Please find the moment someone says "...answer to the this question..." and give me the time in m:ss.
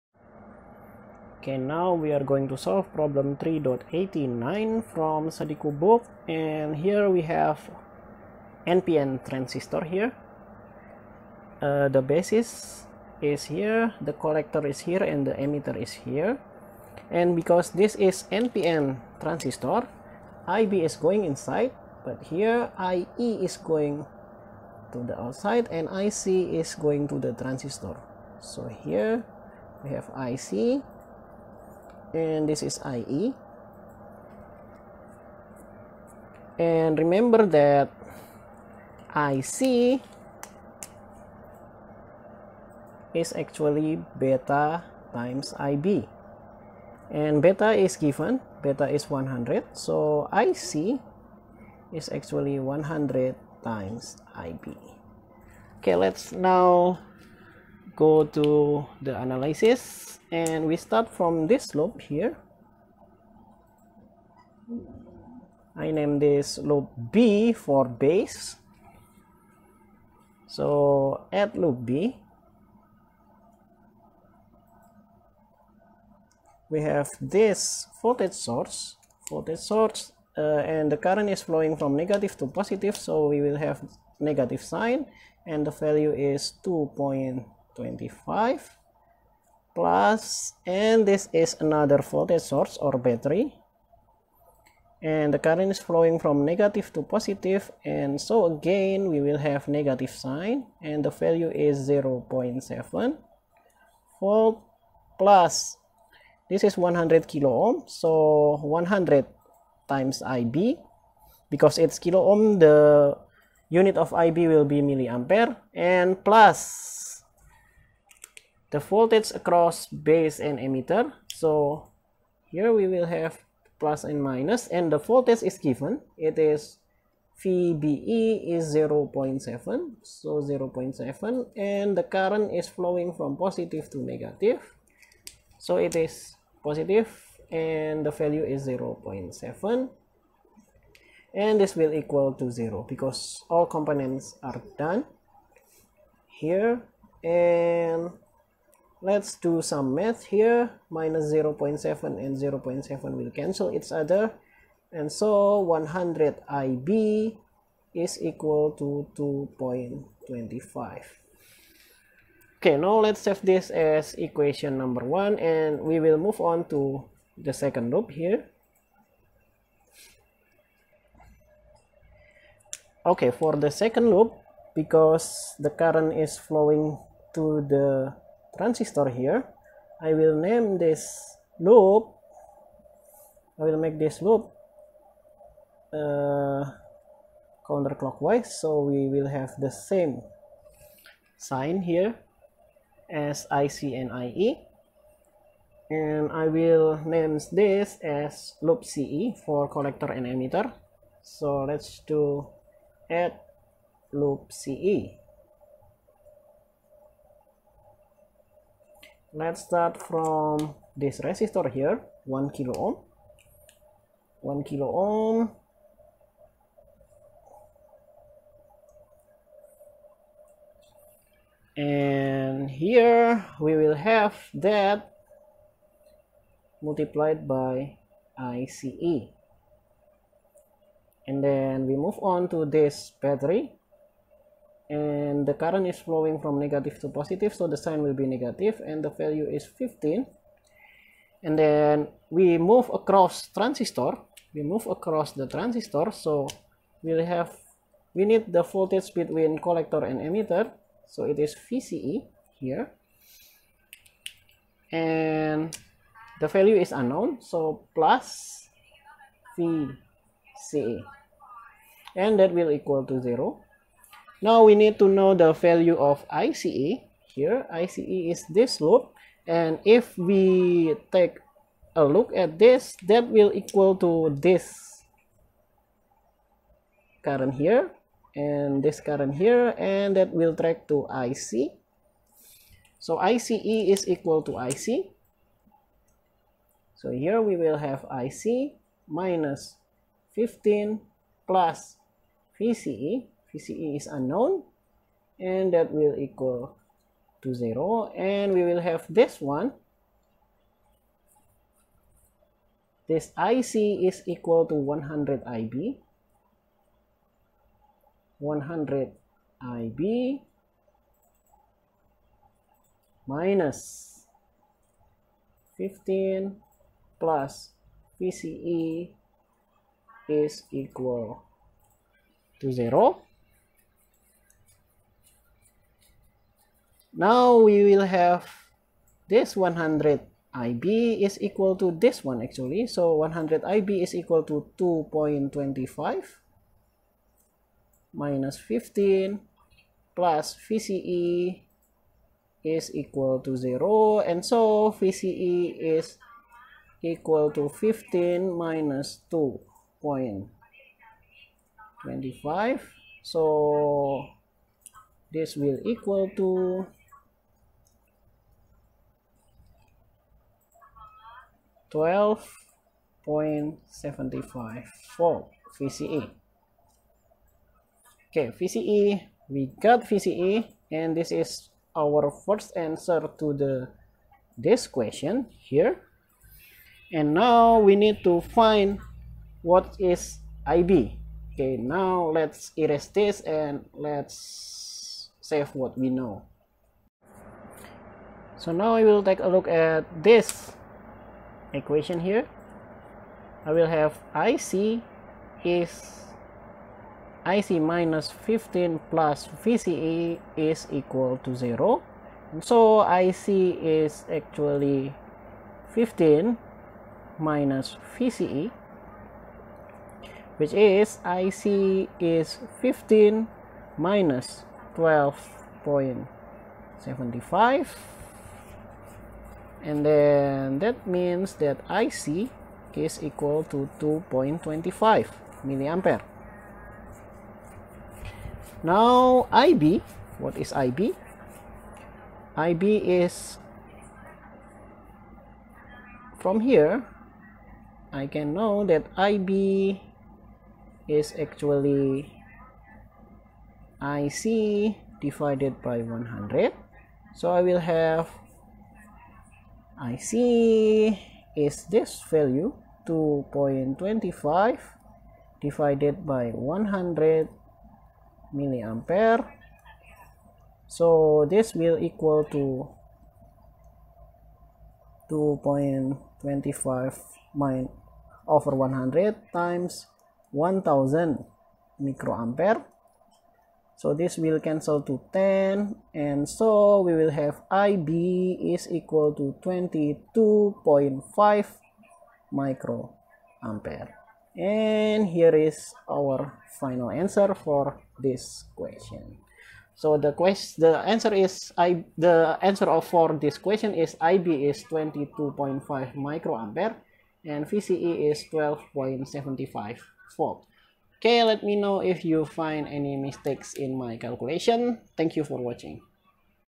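6:12.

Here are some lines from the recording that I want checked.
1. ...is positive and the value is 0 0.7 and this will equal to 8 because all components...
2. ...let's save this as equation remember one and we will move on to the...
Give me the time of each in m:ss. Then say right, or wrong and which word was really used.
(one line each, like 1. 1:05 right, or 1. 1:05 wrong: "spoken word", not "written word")
1. 2:15 wrong: "0", not "8"
2. 2:43 wrong: "number", not "remember".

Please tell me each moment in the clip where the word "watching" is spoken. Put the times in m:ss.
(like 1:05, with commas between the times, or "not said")
8:25.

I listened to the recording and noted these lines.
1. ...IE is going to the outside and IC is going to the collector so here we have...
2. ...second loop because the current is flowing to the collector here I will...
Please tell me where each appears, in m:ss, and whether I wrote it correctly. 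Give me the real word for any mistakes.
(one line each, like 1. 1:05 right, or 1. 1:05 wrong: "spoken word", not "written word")
1. 0:22 wrong: "transistor", not "collector"
2. 2:53 wrong: "transistor", not "collector".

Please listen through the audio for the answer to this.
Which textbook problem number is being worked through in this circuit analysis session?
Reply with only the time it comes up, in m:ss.
0:03.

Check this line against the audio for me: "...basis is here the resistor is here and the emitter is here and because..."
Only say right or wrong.
wrong.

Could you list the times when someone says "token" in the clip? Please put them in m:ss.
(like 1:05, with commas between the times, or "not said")
not said.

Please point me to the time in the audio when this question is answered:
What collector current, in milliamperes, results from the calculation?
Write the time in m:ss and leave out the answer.
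7:03.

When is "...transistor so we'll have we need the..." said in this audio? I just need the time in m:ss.
4:05.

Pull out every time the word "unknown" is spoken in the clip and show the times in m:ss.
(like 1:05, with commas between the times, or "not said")
4:16, 4:54.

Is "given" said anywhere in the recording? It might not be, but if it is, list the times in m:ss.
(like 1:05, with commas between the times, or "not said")
0:47, 2:05.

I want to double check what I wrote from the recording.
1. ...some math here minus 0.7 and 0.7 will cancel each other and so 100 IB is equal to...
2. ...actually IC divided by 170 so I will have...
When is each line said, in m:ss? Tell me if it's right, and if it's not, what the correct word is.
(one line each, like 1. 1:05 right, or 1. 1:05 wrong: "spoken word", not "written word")
1. 2:29 right
2. 7:21 wrong: "100", not "170".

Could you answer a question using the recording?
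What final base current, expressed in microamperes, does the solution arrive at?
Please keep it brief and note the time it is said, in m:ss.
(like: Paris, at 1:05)
22.5 microampere, at 7:59.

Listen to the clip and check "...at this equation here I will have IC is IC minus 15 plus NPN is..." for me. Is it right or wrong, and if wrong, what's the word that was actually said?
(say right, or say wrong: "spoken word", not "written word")
wrong: "VCE", not "NPN".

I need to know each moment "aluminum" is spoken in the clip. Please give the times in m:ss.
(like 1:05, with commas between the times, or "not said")
not said.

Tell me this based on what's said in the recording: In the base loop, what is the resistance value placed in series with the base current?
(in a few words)
100 kilo ohm.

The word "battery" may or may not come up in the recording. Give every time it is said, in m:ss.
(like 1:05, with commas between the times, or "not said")
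1:32, 3:53.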